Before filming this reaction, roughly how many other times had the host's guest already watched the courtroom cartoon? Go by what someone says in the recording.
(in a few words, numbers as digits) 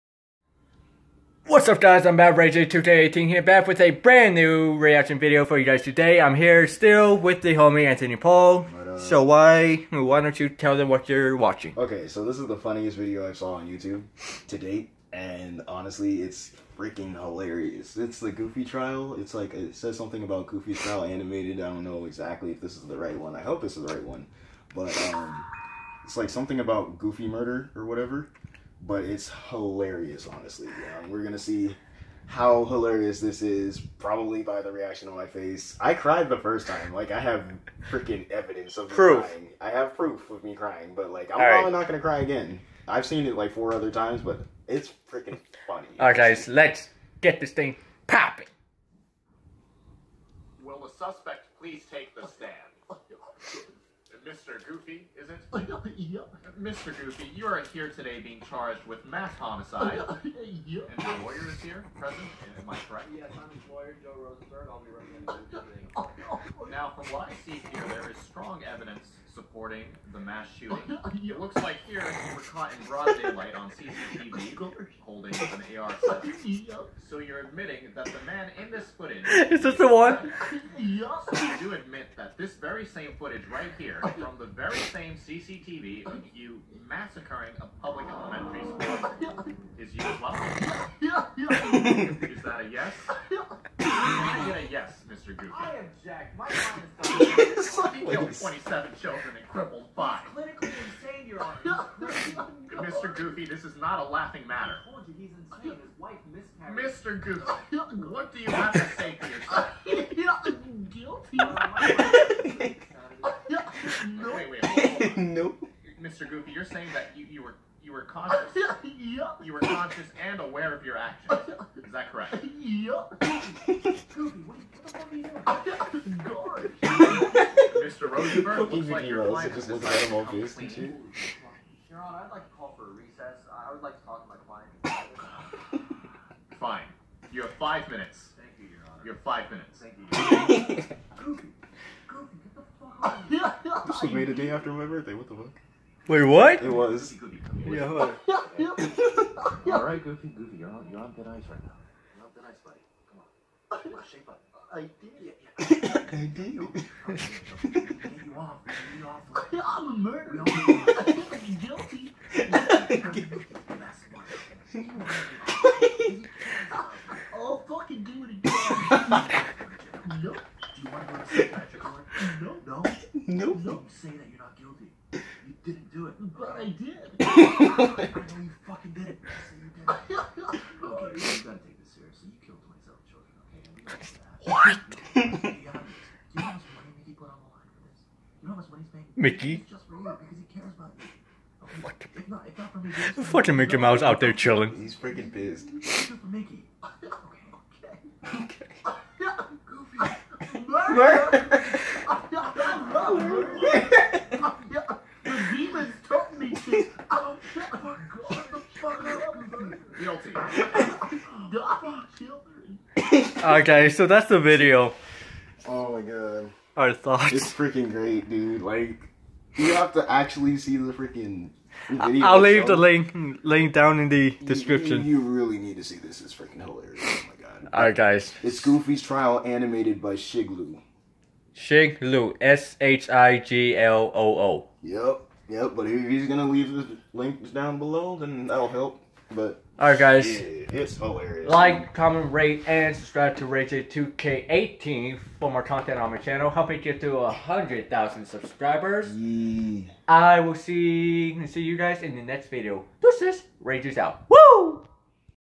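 4.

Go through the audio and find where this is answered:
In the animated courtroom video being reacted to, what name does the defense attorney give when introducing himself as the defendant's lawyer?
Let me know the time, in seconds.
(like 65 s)
64 s.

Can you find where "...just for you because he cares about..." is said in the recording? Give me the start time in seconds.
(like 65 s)
189 s.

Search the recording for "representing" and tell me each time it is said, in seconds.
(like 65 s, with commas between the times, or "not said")
64 s.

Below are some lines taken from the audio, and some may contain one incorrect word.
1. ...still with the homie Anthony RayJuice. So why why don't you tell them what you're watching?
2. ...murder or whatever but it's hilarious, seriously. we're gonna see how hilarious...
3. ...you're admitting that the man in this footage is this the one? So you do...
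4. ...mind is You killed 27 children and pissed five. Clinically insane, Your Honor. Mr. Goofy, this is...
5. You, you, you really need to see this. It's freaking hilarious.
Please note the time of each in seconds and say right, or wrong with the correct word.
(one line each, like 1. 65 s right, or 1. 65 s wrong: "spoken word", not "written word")
1. 6 s wrong: "Paul", not "RayJuice"
2. 27 s wrong: "honestly", not "seriously"
3. 77 s right
4. 96 s wrong: "crippled", not "pissed"
5. 225 s right.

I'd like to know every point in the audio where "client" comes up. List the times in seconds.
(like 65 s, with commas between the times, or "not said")
129 s, 134 s.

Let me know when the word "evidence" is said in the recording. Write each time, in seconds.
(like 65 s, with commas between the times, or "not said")
38 s, 68 s.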